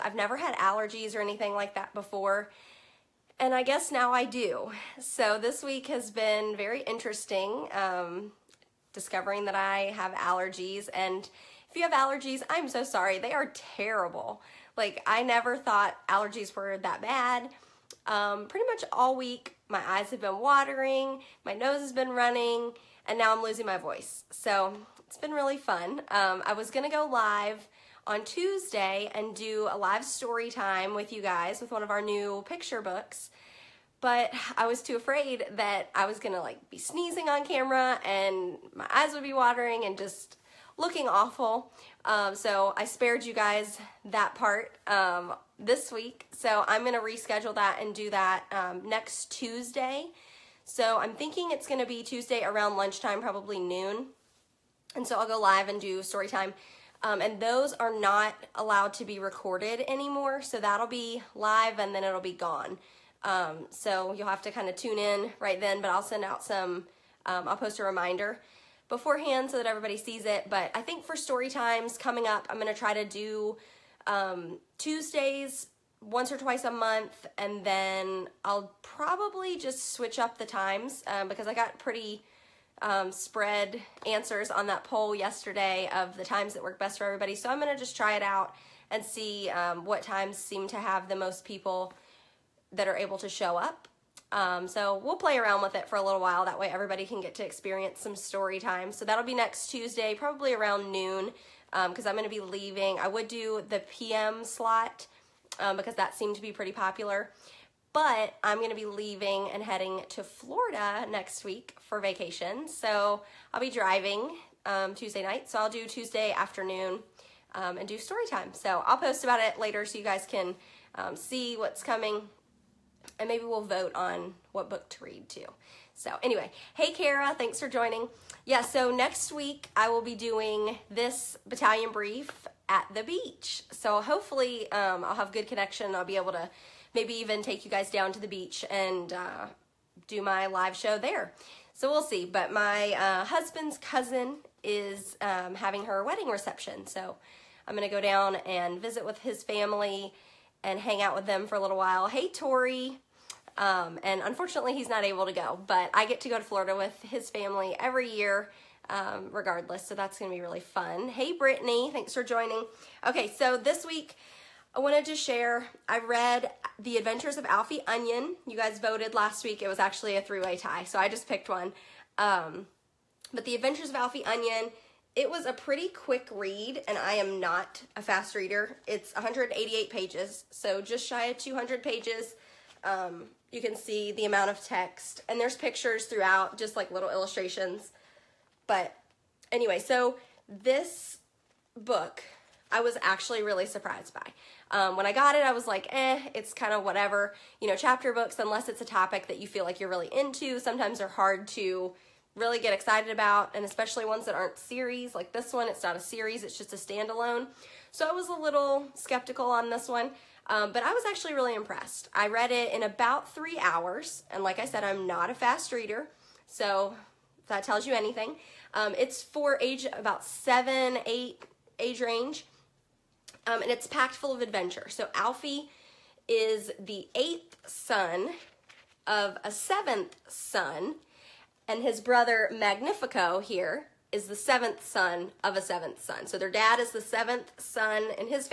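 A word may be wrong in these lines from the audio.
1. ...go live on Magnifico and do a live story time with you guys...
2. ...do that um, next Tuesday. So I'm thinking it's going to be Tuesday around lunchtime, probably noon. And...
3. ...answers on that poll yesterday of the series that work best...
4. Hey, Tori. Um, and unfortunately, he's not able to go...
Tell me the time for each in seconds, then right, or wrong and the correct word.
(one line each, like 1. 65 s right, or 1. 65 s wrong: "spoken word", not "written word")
1. 26 s wrong: "Tuesday", not "Magnifico"
2. 47 s right
3. 84 s wrong: "times", not "series"
4. 152 s right.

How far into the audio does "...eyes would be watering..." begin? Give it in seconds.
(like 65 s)
38 s.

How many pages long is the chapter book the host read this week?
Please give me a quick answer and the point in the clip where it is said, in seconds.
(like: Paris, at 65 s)
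188, at 179 s.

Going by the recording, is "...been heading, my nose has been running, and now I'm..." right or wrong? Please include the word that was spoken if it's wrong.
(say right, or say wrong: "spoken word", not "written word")
wrong: "watering", not "heading".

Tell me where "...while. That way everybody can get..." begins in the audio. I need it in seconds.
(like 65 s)
96 s.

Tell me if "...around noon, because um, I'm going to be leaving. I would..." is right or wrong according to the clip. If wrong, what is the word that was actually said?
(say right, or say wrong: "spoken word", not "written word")
right.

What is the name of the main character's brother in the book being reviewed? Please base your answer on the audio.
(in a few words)
Magnifico.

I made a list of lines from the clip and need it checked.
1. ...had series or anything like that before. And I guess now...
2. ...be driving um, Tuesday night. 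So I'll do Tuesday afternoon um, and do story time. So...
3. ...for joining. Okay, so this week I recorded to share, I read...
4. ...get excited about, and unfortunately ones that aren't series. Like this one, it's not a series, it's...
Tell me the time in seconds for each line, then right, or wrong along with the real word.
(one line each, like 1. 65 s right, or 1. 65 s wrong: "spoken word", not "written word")
1. 0 s wrong: "allergies", not "series"
2. 113 s right
3. 162 s wrong: "wanted", not "recorded"
4. 202 s wrong: "especially", not "unfortunately".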